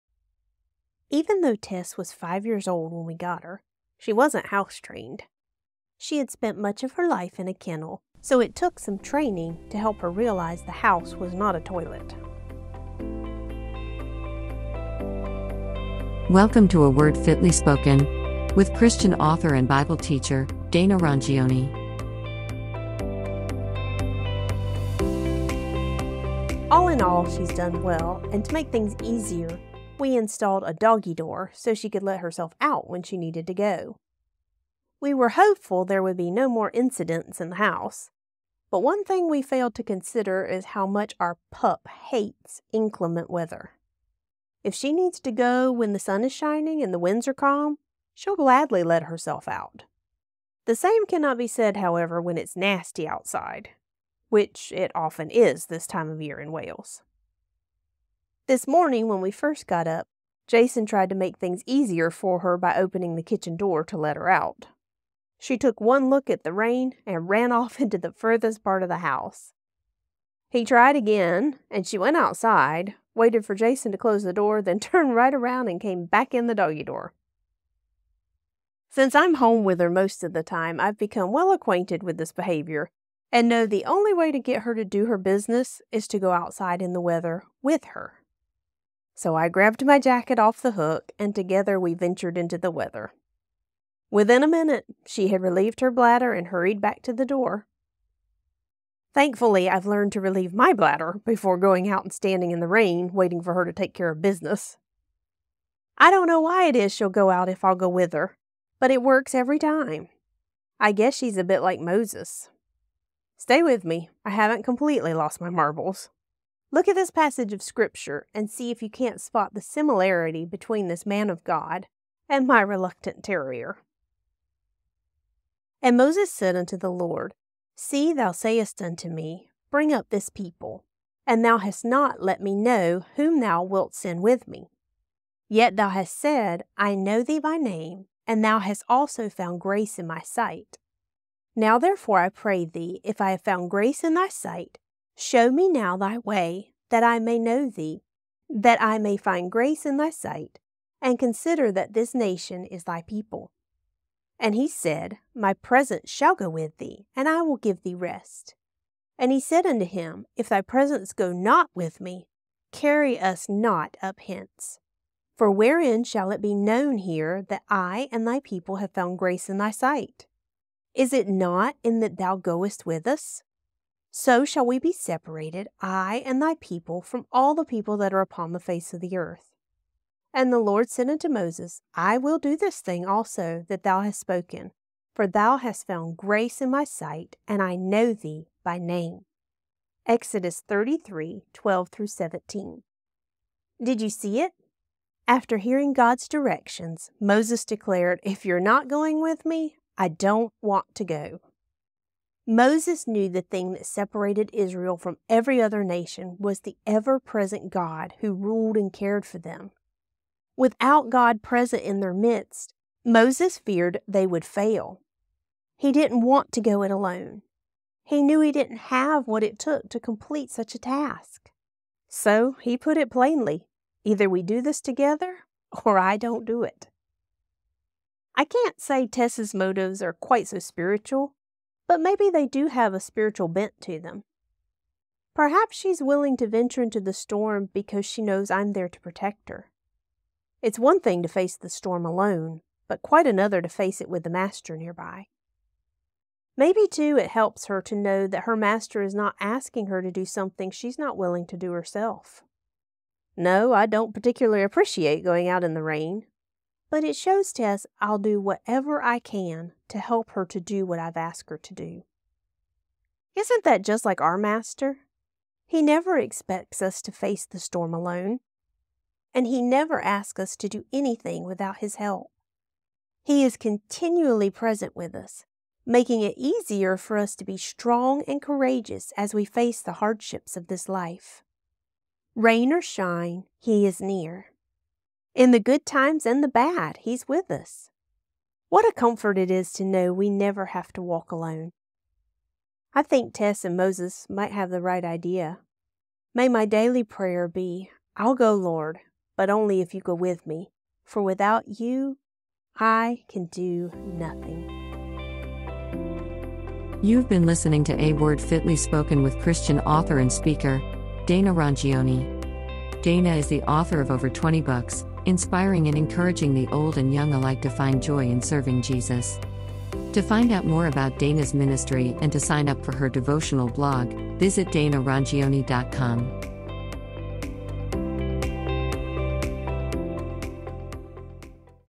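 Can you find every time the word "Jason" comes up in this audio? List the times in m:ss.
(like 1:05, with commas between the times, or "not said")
1:00, 1:13.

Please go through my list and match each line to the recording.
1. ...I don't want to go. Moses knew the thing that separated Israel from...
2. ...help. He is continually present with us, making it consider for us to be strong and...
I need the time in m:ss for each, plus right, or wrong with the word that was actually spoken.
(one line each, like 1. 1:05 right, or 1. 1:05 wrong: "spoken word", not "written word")
1. 3:19 right
2. 4:31 wrong: "easier", not "consider".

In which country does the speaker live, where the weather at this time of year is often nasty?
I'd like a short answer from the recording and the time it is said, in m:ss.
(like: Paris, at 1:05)
Wales, at 0:56.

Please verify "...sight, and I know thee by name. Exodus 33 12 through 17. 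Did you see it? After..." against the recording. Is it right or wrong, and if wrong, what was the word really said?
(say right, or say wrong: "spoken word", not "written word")
right.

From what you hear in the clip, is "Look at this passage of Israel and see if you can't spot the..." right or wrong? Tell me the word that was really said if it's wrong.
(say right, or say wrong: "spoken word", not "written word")
wrong: "Scripture", not "Israel".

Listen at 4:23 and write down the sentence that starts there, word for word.
Isn't that just like our Master?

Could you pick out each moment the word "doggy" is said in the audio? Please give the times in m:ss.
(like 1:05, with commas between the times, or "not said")
0:30, 1:16.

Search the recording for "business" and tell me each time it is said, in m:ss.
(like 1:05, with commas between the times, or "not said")
1:25, 1:44.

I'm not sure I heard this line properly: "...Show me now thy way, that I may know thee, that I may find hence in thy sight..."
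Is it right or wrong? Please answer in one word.
wrong.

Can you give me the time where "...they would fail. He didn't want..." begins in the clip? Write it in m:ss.
3:34.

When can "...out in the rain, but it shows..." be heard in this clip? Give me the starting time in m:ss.
4:15.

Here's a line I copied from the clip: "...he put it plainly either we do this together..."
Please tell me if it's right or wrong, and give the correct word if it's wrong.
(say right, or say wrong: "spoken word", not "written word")
right.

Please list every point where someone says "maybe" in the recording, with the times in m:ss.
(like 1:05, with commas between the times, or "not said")
3:51, 4:06.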